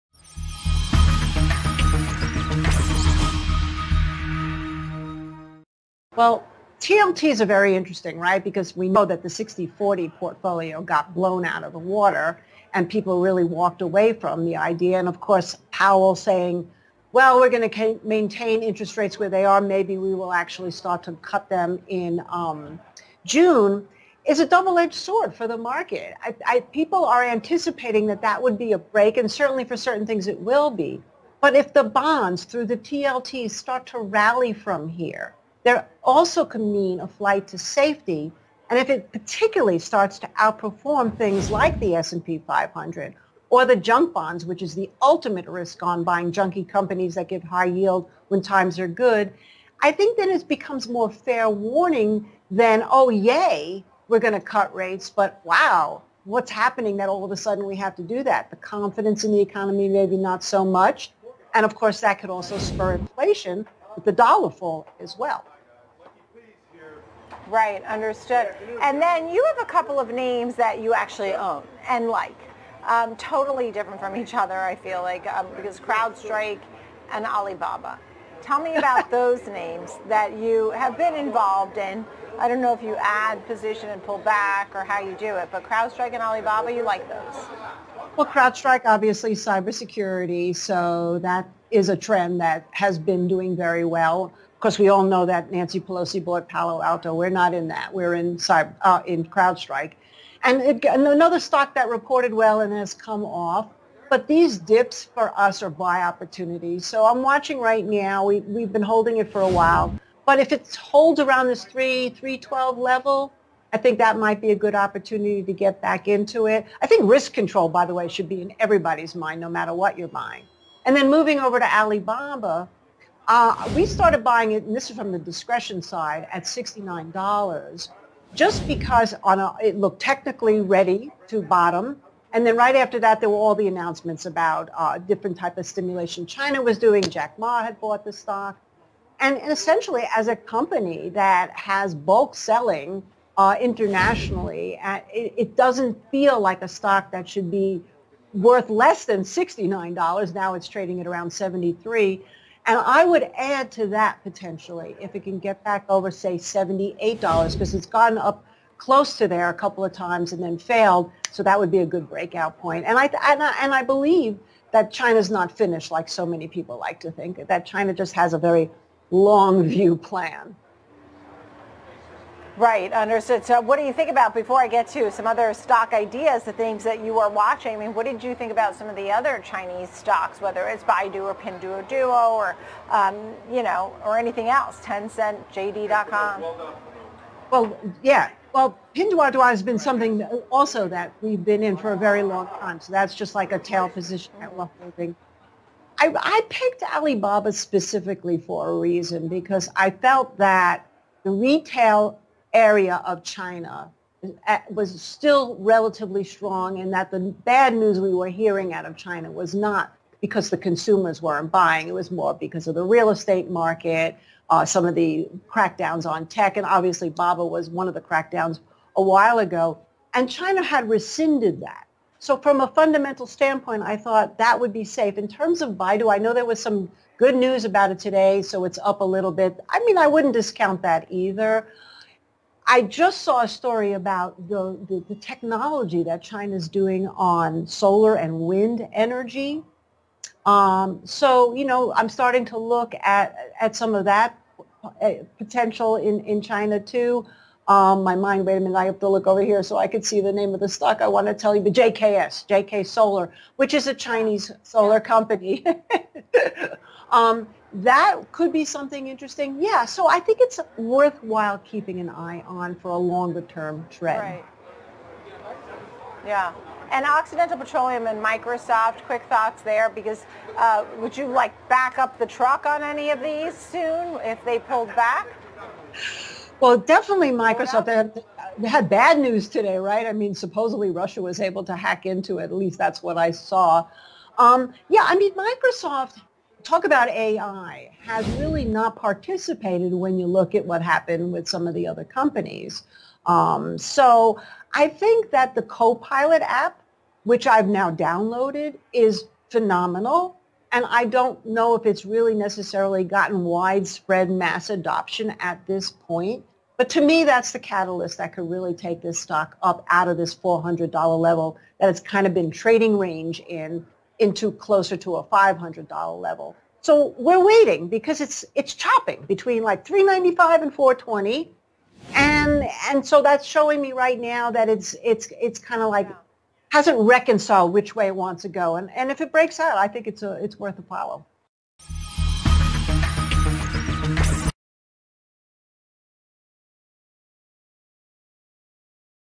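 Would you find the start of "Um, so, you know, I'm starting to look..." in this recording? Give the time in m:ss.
4:00.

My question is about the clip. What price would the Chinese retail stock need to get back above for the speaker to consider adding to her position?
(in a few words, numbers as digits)
$78.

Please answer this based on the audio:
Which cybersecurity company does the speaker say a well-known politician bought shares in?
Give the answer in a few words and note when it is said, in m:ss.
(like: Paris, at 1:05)
Palo Alto, at 1:36.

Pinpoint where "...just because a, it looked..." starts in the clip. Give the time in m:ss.
2:08.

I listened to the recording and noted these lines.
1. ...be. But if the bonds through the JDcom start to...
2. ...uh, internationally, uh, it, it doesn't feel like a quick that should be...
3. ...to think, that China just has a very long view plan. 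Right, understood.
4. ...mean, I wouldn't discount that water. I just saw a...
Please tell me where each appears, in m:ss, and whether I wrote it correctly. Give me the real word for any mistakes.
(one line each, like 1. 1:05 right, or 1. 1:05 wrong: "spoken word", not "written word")
1. 0:30 wrong: "TLT", not "JDcom"
2. 2:23 wrong: "stock", not "quick"
3. 2:47 right
4. 3:49 wrong: "either", not "water".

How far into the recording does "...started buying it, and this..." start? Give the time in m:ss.
2:03.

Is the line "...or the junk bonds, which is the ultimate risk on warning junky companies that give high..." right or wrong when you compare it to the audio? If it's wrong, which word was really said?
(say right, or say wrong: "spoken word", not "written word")
wrong: "buying", not "warning".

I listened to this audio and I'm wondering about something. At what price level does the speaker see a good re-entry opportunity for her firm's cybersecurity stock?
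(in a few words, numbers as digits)
312.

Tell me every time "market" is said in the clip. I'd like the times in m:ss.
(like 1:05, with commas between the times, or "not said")
0:25, 3:33.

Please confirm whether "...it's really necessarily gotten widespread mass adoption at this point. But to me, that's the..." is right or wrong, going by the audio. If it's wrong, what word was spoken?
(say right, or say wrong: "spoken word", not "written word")
right.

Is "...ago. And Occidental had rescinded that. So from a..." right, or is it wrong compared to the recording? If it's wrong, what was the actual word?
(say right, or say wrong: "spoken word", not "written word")
wrong: "China", not "Occidental".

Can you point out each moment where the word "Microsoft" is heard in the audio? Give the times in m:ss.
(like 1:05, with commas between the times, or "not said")
4:28, 4:37, 4:45.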